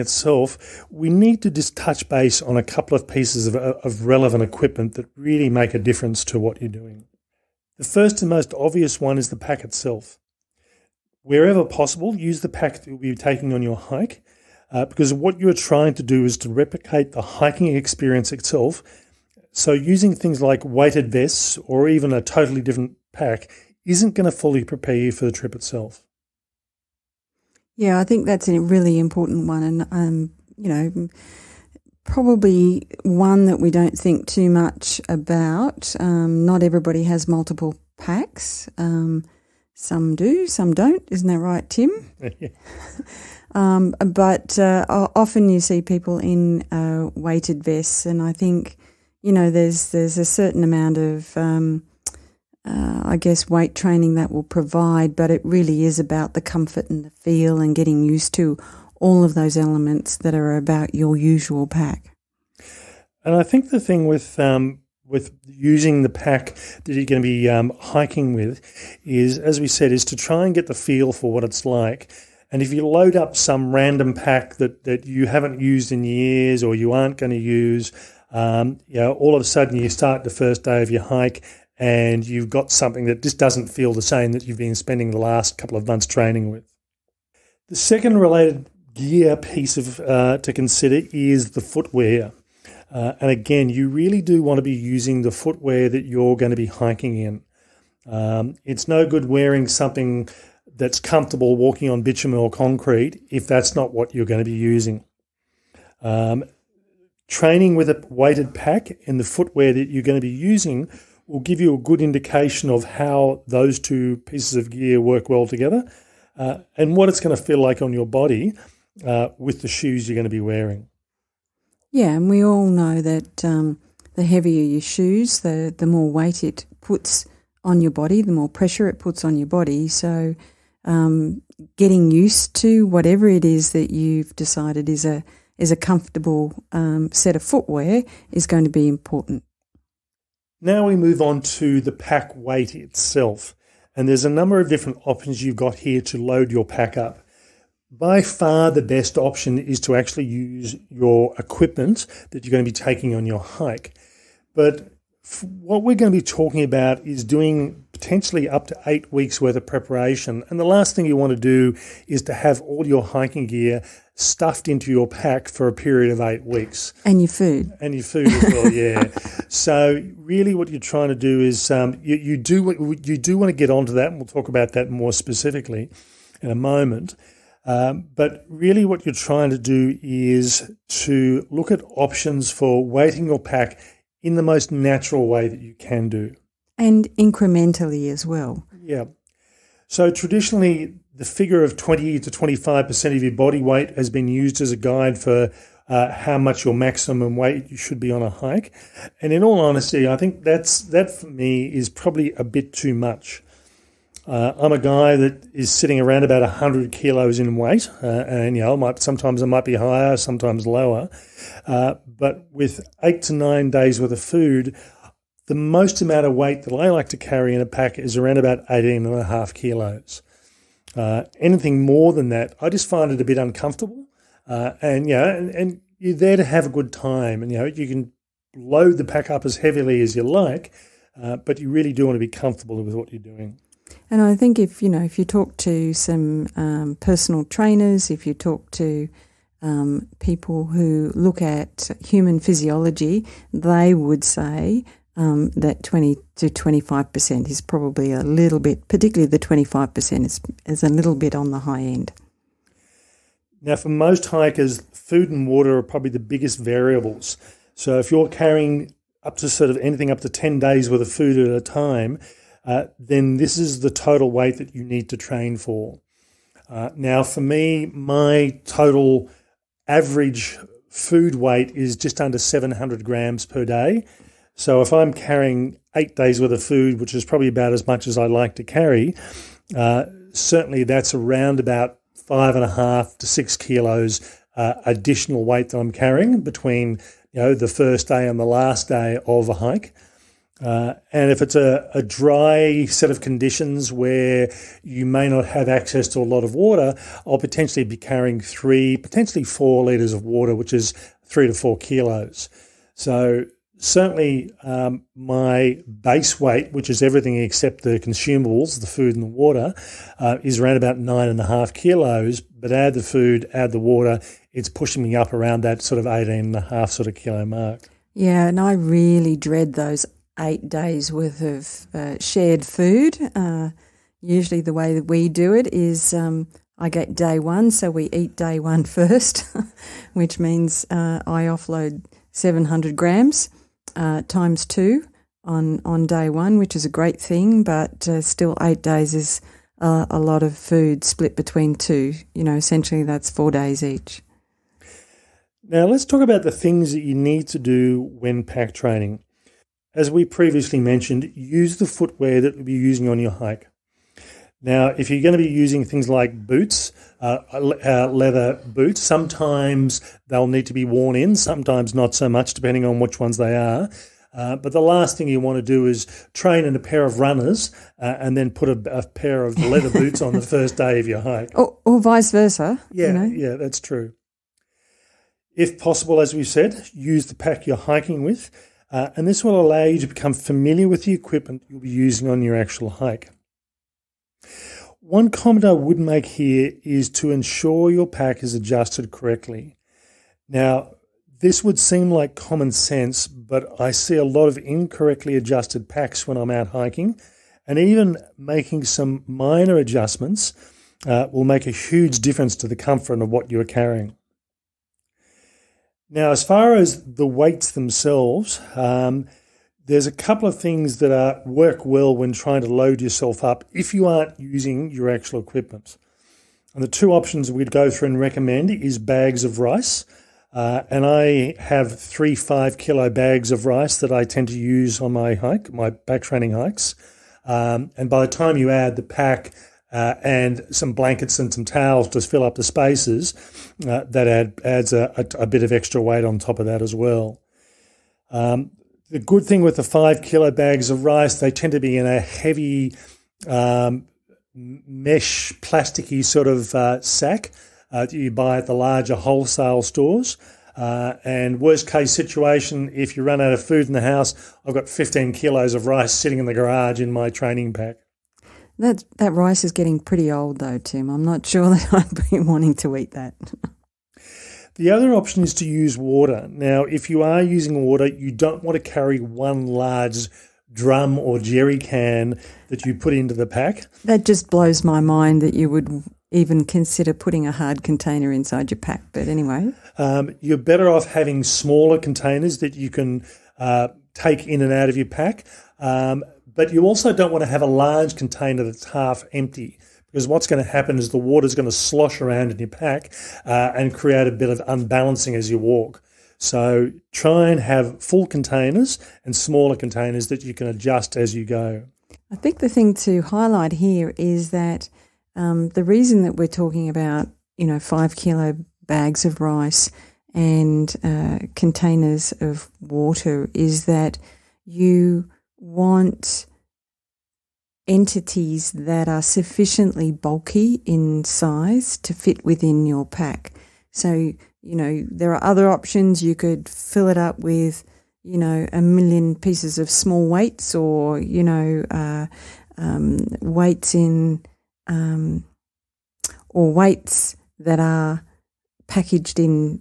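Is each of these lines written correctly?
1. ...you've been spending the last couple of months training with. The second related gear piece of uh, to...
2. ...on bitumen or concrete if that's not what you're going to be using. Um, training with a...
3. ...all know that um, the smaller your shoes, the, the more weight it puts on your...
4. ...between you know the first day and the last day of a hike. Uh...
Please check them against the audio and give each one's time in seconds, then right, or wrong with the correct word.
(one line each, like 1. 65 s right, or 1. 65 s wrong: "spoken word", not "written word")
1. 84 s right
2. 101 s right
3. 122 s wrong: "heavier", not "smaller"
4. 286 s right.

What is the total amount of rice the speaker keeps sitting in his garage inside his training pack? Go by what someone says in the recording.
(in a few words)
15 kilos.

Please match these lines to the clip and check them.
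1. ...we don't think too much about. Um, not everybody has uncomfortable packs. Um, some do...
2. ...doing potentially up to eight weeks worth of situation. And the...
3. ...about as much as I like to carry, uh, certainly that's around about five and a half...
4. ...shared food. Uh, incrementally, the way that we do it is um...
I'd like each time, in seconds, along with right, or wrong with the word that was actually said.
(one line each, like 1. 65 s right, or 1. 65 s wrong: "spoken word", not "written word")
1. 33 s wrong: "multiple", not "uncomfortable"
2. 157 s wrong: "preparation", not "situation"
3. 277 s right
4. 322 s wrong: "usually", not "incrementally".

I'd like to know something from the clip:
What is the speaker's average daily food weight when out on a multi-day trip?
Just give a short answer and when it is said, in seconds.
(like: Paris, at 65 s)
just under 700 grams, at 271 s.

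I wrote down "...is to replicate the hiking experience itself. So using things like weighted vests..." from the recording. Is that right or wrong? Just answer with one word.
right.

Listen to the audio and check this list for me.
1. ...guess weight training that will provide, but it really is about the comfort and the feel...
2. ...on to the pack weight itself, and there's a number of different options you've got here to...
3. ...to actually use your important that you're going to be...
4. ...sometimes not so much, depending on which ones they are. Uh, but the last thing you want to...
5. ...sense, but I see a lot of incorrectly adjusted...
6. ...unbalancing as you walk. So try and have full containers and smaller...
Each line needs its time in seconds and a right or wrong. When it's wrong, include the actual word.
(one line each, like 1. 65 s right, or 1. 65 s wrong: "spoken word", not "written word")
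1. 53 s right
2. 141 s right
3. 149 s wrong: "equipment", not "important"
4. 361 s right
5. 392 s right
6. 494 s right.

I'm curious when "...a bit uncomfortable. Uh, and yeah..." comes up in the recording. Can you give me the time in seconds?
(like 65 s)
223 s.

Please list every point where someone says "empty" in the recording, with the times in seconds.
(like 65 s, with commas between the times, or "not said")
489 s.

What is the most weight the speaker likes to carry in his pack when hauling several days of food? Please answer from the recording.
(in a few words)
18.5 kilos.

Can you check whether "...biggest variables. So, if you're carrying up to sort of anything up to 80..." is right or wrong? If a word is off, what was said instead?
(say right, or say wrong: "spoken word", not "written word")
wrong: "10", not "80".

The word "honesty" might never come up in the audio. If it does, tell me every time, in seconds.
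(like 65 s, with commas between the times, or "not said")
199 s.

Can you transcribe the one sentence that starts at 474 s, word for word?
That just blows my mind that you would even consider putting a hard container inside your pack.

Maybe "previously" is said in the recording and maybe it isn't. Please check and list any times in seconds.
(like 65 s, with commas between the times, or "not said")
350 s.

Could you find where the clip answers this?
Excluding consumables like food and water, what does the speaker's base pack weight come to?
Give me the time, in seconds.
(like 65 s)
310 s.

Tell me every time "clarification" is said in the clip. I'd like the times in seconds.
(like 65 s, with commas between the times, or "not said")
not said.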